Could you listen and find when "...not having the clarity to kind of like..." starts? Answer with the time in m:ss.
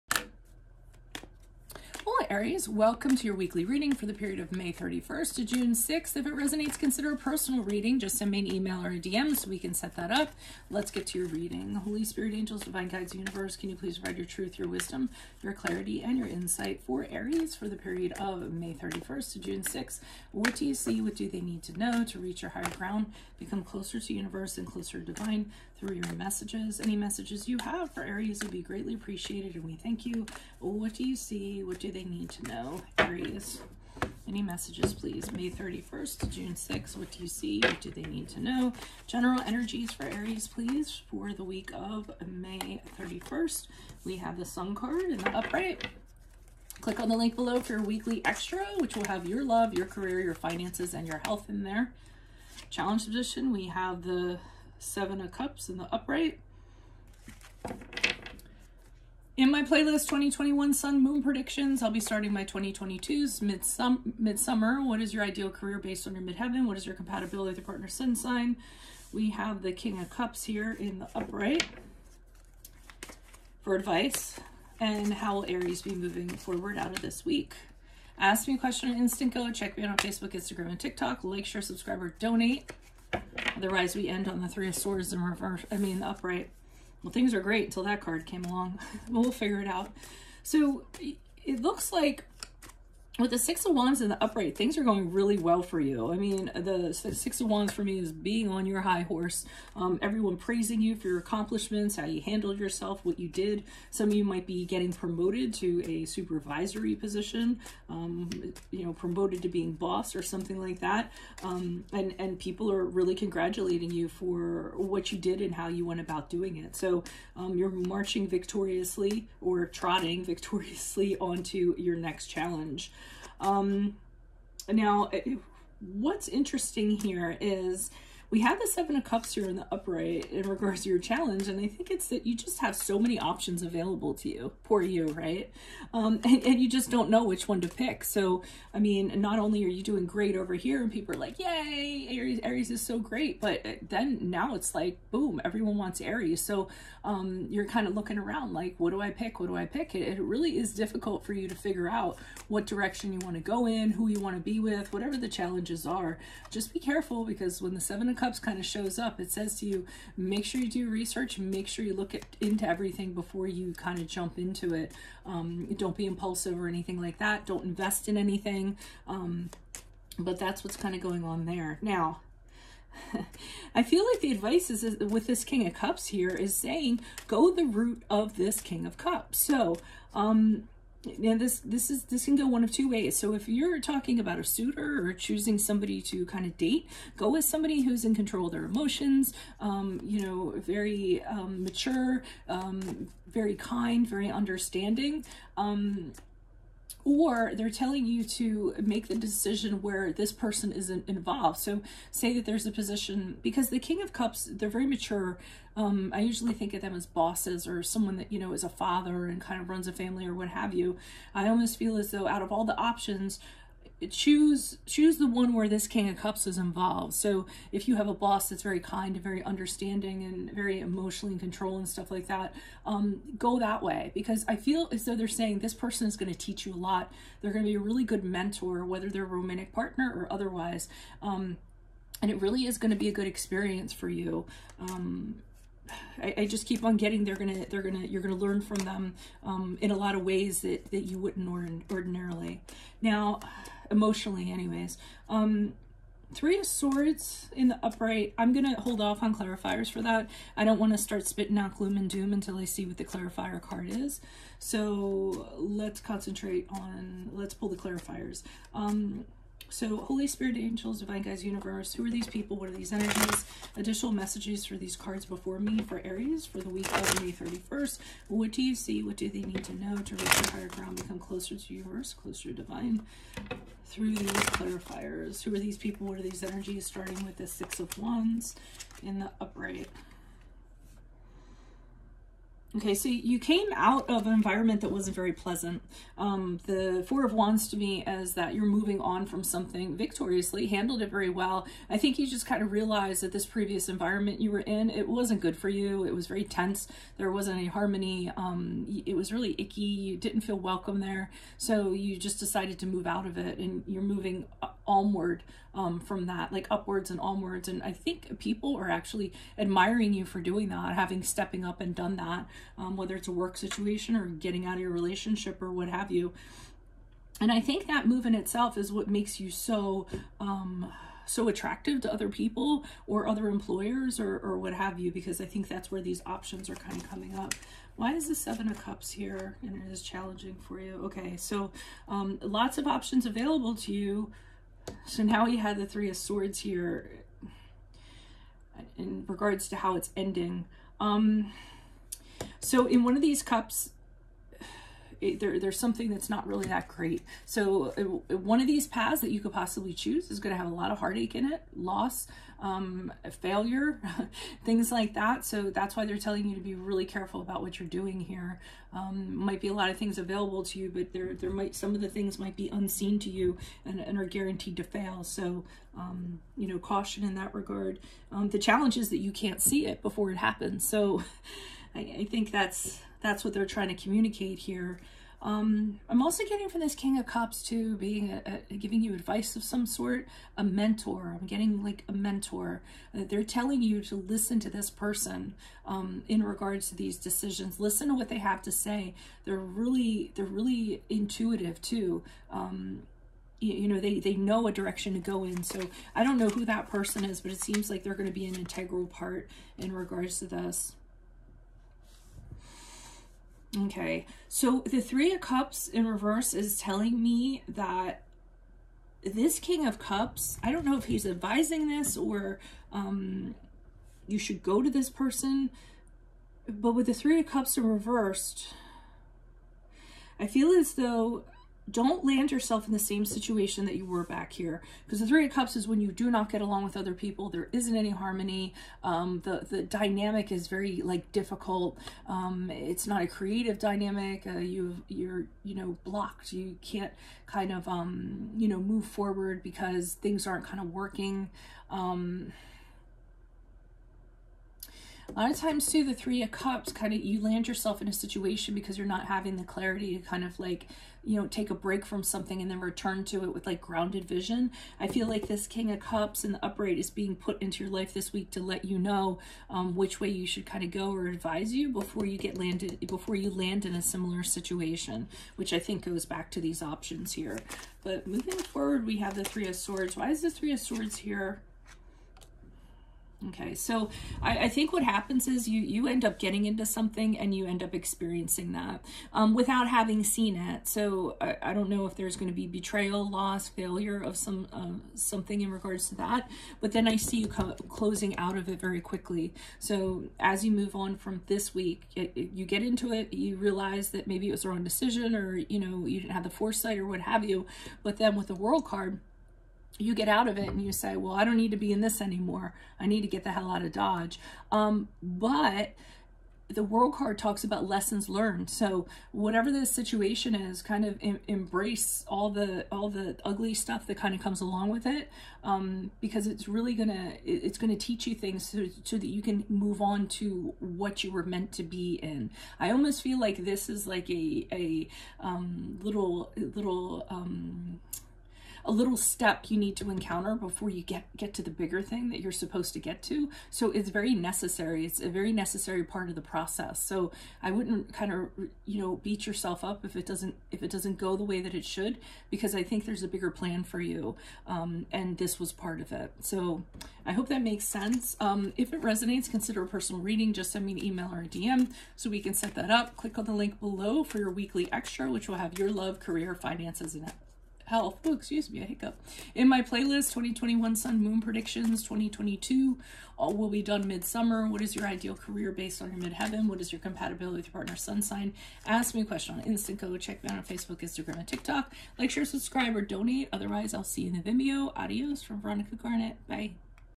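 7:29.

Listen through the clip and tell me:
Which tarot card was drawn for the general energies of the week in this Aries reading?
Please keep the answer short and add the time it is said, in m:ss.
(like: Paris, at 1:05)
The Sun, at 0:44.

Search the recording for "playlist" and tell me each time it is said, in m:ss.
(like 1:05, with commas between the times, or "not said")
0:59, 9:19.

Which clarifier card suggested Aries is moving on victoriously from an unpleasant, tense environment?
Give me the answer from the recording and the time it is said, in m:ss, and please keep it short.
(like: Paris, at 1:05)
Four of Wands, at 4:47.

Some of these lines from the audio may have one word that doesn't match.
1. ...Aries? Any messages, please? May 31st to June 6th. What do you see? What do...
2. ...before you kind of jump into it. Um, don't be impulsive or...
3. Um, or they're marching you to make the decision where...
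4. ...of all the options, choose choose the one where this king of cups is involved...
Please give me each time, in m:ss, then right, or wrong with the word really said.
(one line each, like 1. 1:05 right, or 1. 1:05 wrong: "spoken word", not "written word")
1. 0:32 right
2. 2:43 right
3. 3:15 wrong: "telling", not "marching"
4. 3:32 right.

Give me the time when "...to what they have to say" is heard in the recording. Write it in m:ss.
6:28.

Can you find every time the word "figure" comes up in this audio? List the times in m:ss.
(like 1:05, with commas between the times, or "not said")
1:29, 2:31.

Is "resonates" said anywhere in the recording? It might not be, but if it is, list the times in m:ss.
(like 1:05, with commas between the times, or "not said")
0:06, 9:09.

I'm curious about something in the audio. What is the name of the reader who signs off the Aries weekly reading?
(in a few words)
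Veronica Garnet.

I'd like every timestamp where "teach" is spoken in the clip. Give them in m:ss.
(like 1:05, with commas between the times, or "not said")
3:46, 8:37.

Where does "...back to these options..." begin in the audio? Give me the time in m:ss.
7:46.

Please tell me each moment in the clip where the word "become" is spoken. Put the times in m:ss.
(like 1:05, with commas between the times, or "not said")
0:23, 4:30.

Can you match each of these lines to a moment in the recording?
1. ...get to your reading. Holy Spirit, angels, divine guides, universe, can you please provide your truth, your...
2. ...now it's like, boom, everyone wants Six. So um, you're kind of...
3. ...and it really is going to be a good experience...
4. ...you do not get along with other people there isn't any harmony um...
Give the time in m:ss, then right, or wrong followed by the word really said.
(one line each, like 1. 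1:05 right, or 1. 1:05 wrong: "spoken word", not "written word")
1. 0:10 right
2. 2:24 wrong: "Aries", not "Six"
3. 3:52 right
4. 7:05 right.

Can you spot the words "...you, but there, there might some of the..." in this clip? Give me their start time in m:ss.
6:00.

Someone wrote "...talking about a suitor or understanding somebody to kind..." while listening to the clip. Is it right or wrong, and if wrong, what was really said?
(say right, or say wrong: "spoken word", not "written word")
wrong: "choosing", not "understanding".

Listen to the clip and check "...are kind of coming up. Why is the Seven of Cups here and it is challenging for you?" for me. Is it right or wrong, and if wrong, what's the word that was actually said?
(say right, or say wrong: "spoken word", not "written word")
right.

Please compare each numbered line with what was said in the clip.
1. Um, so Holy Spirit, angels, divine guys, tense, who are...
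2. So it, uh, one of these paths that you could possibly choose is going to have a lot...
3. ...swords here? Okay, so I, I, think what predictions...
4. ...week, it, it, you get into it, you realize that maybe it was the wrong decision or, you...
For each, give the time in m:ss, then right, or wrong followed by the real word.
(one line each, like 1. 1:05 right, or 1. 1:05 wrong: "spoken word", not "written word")
1. 4:18 wrong: "universe", not "tense"
2. 5:47 right
3. 7:50 wrong: "happens", not "predictions"
4. 8:11 right.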